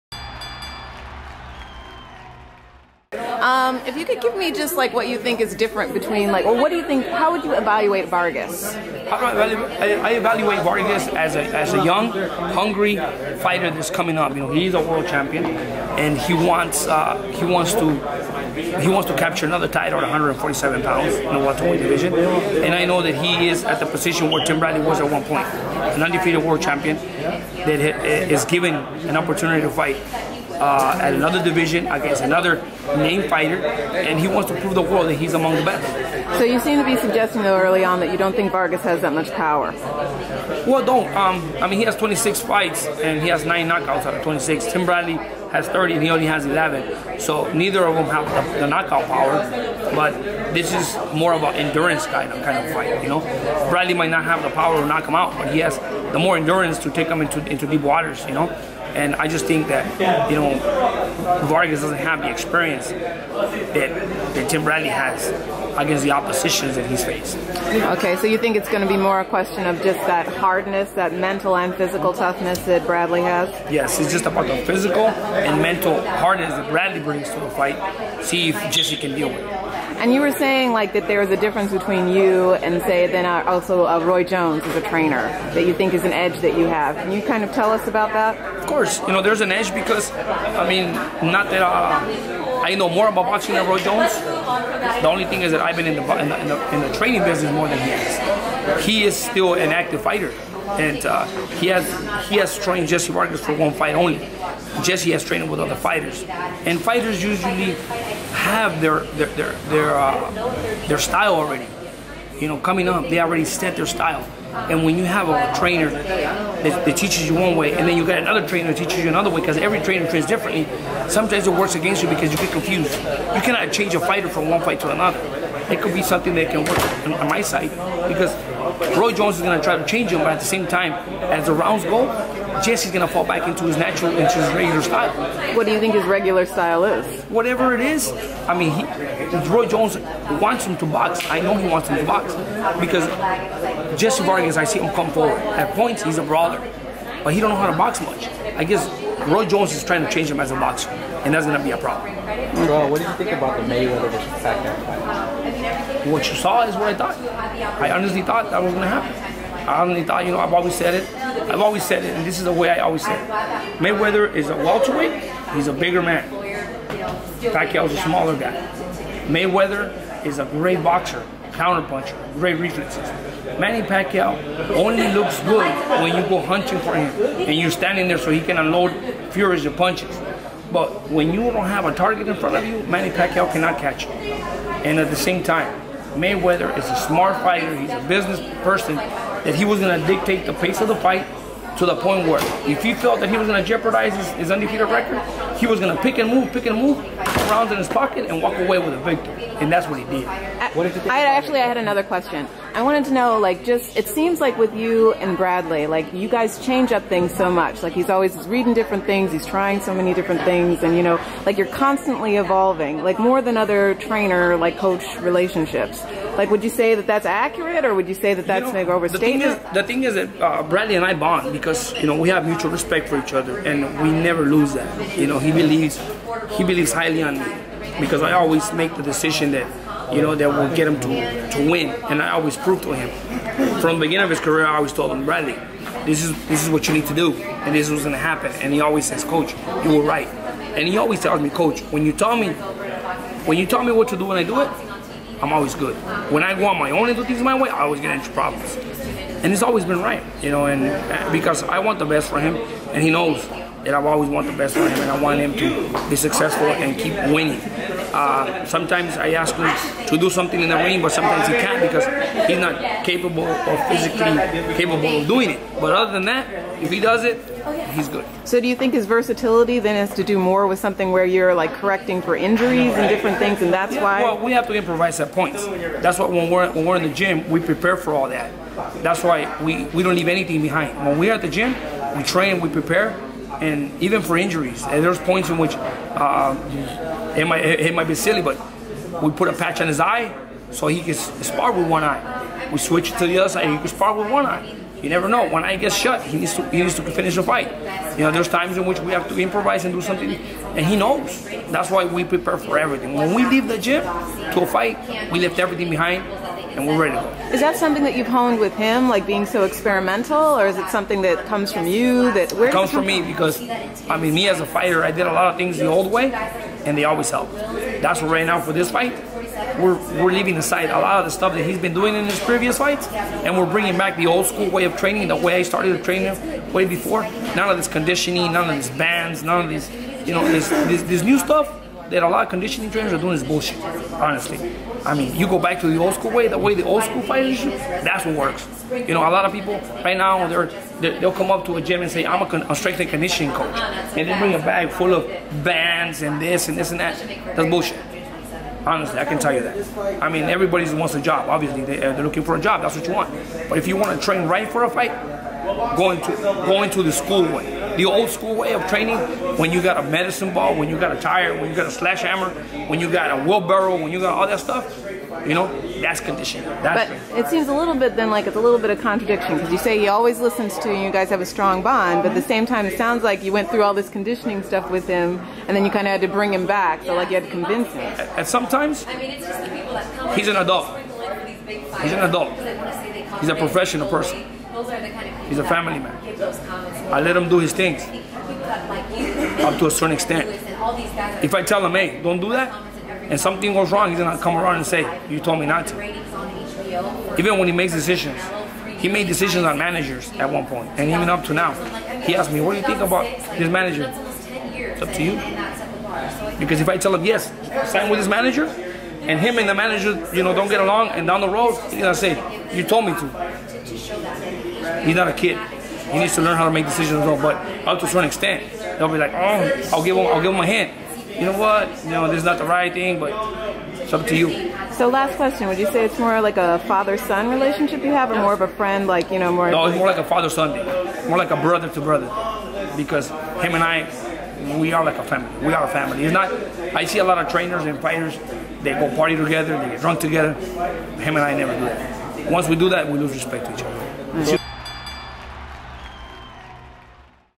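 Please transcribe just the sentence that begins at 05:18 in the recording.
That's what right now for this fight.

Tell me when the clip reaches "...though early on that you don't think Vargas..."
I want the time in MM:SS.
00:37.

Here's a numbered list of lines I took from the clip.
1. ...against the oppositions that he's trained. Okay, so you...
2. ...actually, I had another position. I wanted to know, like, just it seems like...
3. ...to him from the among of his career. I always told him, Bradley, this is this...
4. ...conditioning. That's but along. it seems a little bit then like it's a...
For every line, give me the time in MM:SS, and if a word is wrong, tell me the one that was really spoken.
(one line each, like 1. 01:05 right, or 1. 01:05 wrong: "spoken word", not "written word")
1. 01:05 wrong: "faced", not "trained"
2. 03:21 wrong: "question", not "position"
3. 03:52 wrong: "beginning", not "among"
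4. 06:06 wrong: "training", not "along".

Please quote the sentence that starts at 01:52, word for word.
You know, coming up, they already set their style.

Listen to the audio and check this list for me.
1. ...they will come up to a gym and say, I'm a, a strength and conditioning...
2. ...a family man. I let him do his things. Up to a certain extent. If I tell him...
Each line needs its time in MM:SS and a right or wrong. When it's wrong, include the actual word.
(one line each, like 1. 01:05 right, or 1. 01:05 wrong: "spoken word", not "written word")
1. 05:40 right
2. 06:25 right.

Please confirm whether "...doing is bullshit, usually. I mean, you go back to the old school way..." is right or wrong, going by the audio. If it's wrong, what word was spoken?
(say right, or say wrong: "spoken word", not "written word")
wrong: "honestly", not "usually".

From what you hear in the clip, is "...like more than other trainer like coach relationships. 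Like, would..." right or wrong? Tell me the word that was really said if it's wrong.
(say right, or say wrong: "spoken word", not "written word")
right.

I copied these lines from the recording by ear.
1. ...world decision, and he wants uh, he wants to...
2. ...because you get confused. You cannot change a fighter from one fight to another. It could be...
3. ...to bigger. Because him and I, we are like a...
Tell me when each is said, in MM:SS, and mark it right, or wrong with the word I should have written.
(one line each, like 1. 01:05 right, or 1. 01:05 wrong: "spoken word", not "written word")
1. 00:14 wrong: "champion", not "decision"
2. 02:02 right
3. 07:11 wrong: "brother", not "bigger".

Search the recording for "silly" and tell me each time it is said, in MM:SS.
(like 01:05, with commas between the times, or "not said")
04:48.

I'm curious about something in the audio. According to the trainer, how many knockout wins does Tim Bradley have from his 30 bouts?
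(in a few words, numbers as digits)
11.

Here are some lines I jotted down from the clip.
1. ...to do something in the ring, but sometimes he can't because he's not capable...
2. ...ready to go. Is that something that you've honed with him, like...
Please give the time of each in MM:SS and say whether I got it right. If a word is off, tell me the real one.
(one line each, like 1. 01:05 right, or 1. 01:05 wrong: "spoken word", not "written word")
1. 04:20 right
2. 05:06 right.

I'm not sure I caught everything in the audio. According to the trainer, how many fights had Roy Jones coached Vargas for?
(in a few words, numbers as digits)
1.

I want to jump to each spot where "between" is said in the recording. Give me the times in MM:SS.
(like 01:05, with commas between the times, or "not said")
00:05, 01:21.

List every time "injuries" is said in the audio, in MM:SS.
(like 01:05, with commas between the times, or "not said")
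04:32, 04:44.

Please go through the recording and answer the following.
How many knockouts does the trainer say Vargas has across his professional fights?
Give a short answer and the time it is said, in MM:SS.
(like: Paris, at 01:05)
9, at 00:43.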